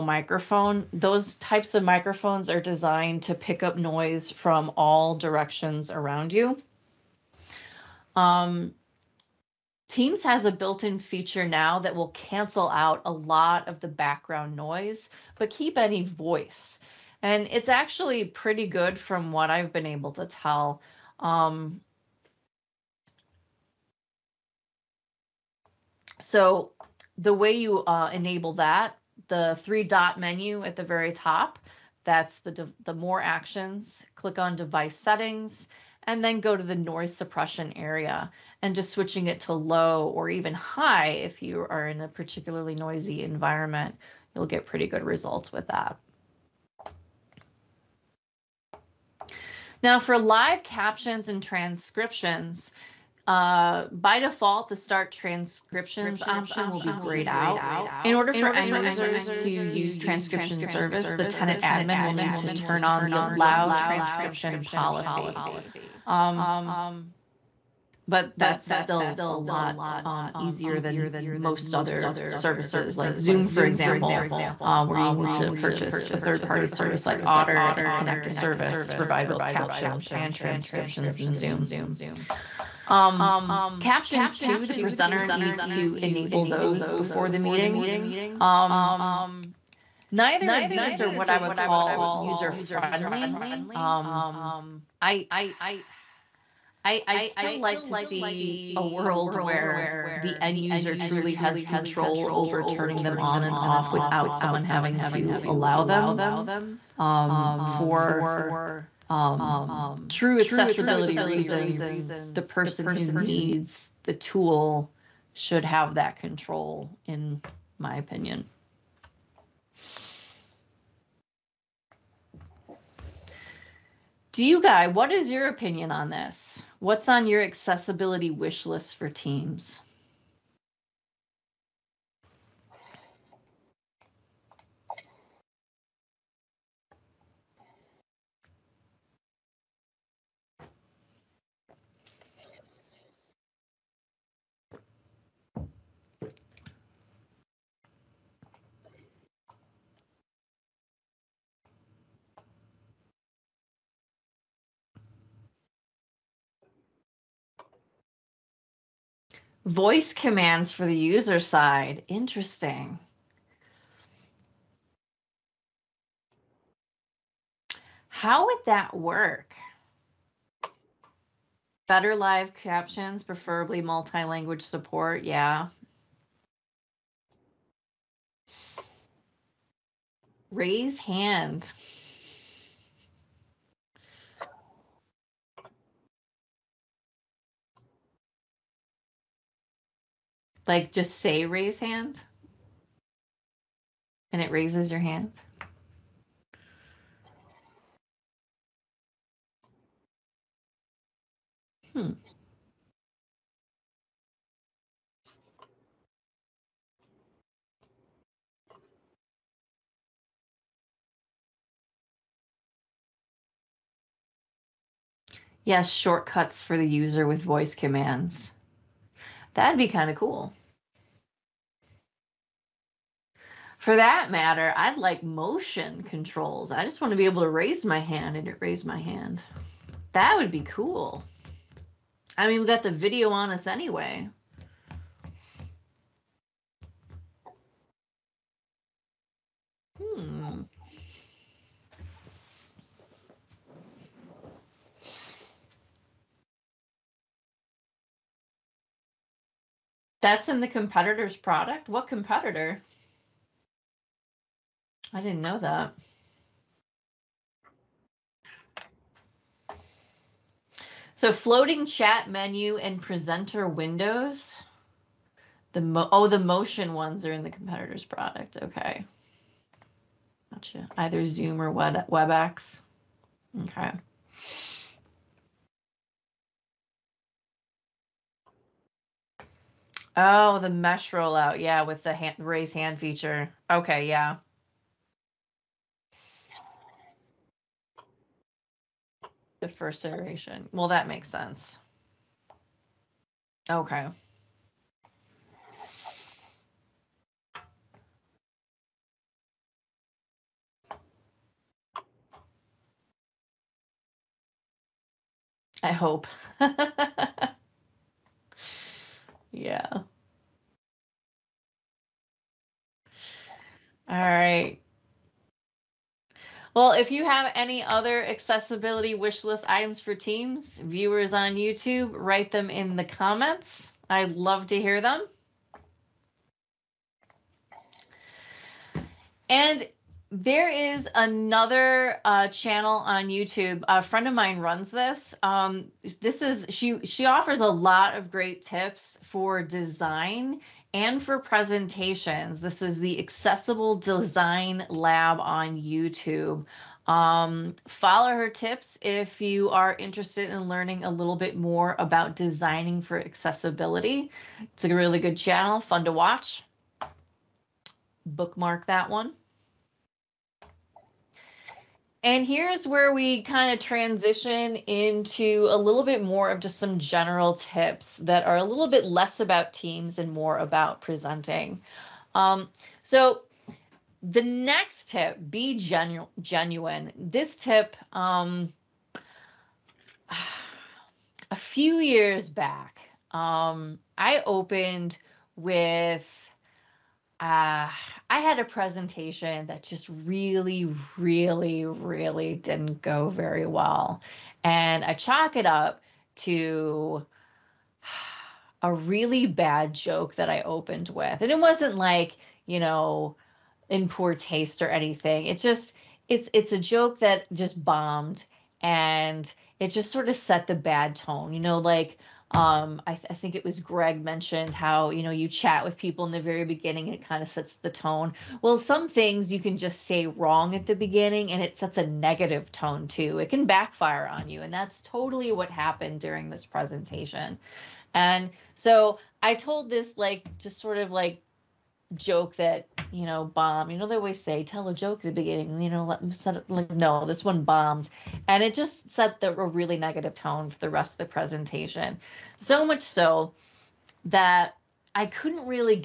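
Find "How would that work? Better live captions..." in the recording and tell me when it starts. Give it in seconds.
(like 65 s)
168 s.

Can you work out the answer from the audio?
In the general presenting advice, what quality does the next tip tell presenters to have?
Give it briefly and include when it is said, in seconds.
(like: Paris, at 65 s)
genuine, at 375 s.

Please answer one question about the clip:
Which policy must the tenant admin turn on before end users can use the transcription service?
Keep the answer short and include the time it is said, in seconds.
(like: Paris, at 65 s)
allow transcription policy, at 63 s.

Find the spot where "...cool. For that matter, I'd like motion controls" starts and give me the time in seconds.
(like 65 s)
220 s.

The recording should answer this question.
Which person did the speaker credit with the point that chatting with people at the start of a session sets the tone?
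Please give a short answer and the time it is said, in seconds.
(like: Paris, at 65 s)
Greg, at 413 s.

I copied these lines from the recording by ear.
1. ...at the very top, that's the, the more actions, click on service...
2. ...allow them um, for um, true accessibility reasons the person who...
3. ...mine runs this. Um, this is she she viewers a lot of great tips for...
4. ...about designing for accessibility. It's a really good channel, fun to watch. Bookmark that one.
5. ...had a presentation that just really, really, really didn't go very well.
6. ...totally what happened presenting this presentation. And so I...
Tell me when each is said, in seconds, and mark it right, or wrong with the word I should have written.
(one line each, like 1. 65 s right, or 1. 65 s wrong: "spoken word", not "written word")
1. 30 s wrong: "device", not "service"
2. 105 s right
3. 334 s wrong: "offers", not "viewers"
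4. 351 s right
5. 388 s right
6. 425 s wrong: "during", not "presenting".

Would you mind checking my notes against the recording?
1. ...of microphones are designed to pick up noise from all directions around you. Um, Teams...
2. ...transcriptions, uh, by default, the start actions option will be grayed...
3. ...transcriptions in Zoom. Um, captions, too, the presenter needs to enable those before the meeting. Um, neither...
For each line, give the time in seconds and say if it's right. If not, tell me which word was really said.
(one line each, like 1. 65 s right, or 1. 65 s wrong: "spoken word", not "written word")
1. 1 s right
2. 51 s wrong: "transcriptions", not "actions"
3. 80 s right.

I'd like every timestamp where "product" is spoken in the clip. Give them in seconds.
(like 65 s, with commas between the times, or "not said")
251 s, 268 s.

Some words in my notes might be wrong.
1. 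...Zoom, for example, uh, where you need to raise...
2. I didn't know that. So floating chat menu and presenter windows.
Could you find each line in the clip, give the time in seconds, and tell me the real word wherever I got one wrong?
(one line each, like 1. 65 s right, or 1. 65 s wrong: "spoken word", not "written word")
1. 73 s wrong: "purchase", not "raise"
2. 255 s right.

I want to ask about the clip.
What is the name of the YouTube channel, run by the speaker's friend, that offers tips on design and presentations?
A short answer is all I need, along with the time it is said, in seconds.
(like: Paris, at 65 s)
Accessible Design Lab, at 343 s.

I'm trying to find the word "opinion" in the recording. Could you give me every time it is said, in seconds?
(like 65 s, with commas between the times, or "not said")
117 s, 125 s.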